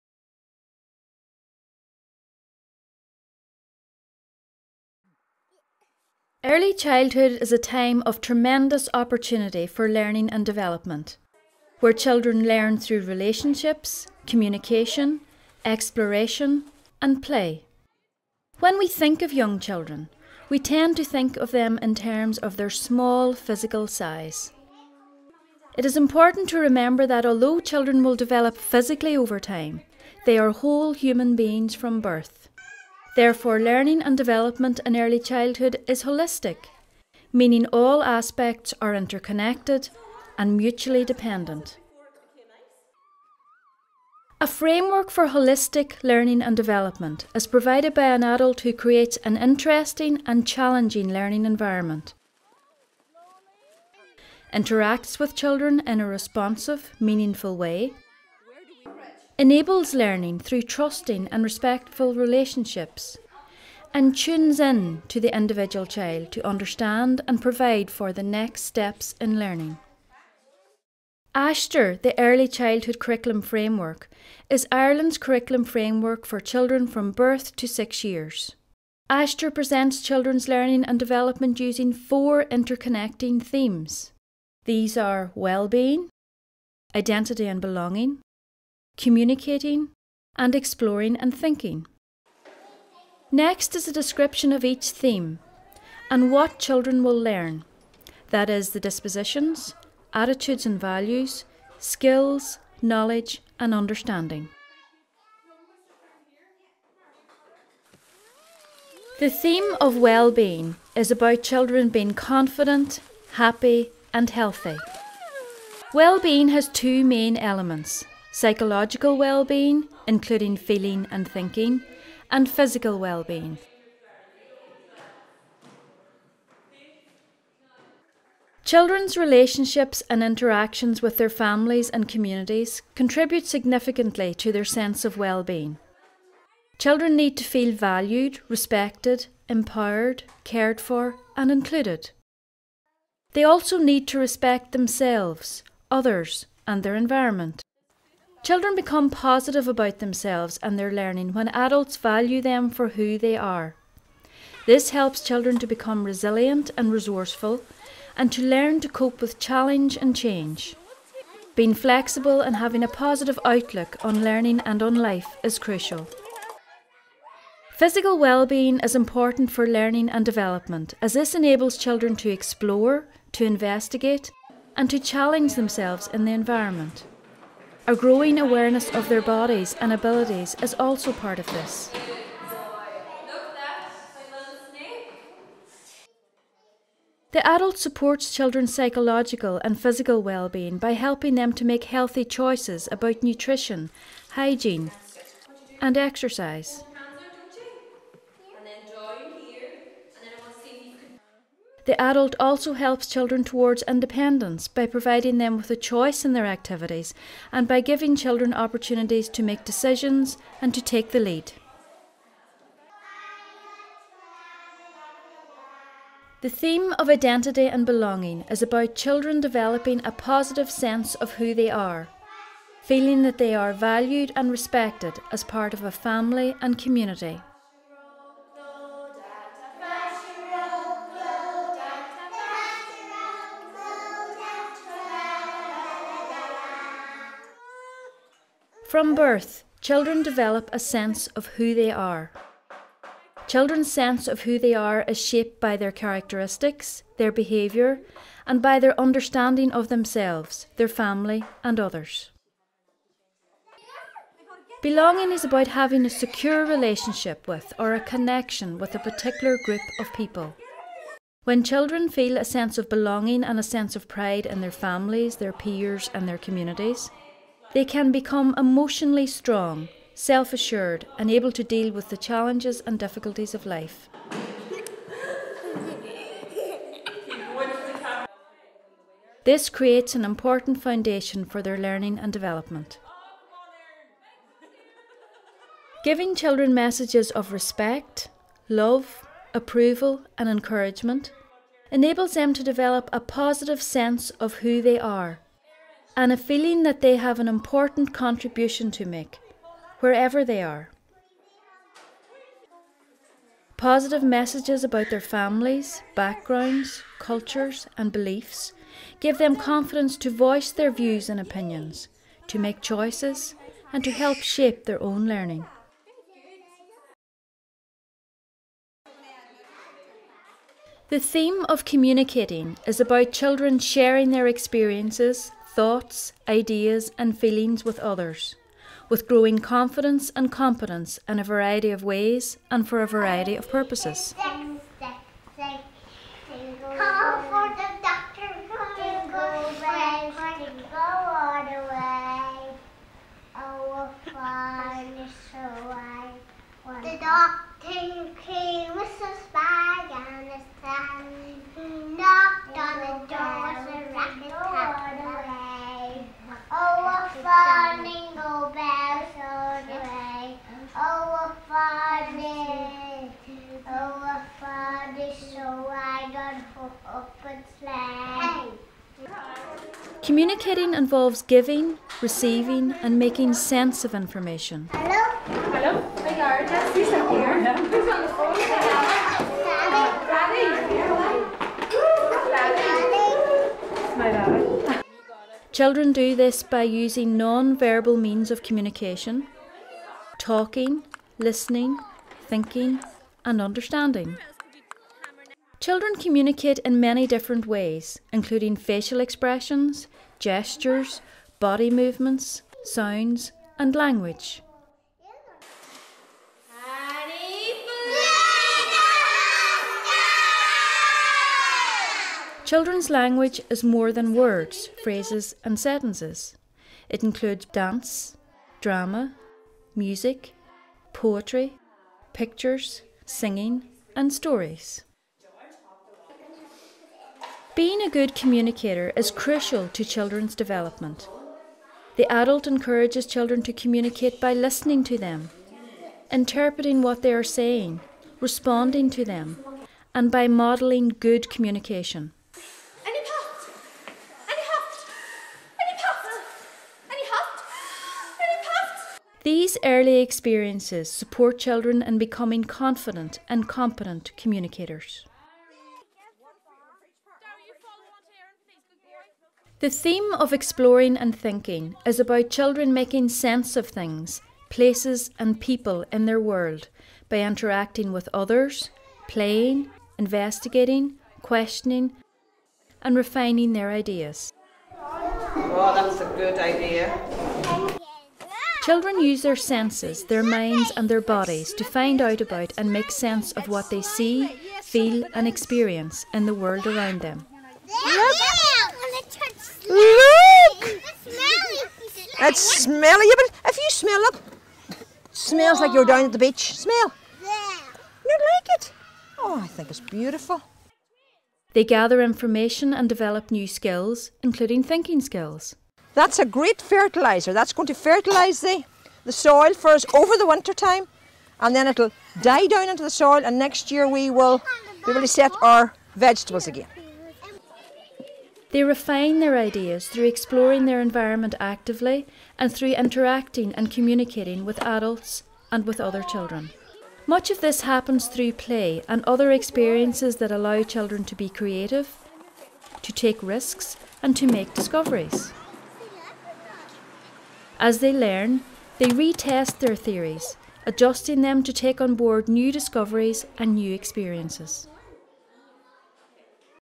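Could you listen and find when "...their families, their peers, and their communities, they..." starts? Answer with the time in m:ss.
4:24.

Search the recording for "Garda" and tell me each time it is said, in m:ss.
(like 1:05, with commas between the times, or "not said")
6:16.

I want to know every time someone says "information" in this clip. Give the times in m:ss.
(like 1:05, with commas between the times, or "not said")
6:14, 8:22.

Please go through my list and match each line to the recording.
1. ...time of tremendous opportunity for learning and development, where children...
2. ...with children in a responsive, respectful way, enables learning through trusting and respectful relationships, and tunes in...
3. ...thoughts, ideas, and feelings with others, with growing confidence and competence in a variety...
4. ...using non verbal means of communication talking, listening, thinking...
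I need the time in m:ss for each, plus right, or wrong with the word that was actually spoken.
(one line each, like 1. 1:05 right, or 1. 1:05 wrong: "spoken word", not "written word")
1. 0:07 right
2. 0:55 wrong: "meaningful", not "respectful"
3. 5:25 right
4. 6:26 right.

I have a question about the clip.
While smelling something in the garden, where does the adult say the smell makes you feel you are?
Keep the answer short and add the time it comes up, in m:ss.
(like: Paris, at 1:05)
At the beach, at 8:16.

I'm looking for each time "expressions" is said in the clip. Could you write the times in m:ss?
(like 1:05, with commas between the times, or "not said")
6:39.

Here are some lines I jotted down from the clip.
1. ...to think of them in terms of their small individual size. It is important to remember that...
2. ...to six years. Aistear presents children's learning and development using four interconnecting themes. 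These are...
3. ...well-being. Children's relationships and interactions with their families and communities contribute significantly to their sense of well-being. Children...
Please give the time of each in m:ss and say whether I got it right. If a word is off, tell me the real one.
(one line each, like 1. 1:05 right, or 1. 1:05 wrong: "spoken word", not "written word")
1. 0:20 wrong: "physical", not "individual"
2. 1:17 right
3. 2:02 right.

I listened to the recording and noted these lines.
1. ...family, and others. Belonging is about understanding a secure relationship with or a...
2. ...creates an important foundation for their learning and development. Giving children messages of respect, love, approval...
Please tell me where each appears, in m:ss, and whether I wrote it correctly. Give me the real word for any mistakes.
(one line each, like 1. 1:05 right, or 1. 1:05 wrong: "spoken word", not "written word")
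1. 4:10 wrong: "having", not "understanding"
2. 4:39 right.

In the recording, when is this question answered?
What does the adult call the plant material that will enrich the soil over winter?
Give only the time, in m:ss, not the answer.
8:26.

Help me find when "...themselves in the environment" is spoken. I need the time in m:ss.
2:55.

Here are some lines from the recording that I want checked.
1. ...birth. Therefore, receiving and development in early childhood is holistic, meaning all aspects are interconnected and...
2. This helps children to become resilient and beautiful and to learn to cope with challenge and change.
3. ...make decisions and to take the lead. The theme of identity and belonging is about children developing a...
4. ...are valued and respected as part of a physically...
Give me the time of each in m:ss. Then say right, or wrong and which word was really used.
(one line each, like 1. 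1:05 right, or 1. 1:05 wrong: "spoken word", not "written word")
1. 0:32 wrong: "learning", not "receiving"
2. 2:34 wrong: "resourceful", not "beautiful"
3. 3:29 right
4. 3:43 wrong: "family", not "physically".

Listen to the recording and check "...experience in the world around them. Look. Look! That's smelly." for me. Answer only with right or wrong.
right.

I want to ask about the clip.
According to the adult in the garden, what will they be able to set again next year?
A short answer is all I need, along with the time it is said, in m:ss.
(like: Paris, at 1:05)
Vegetables, at 8:36.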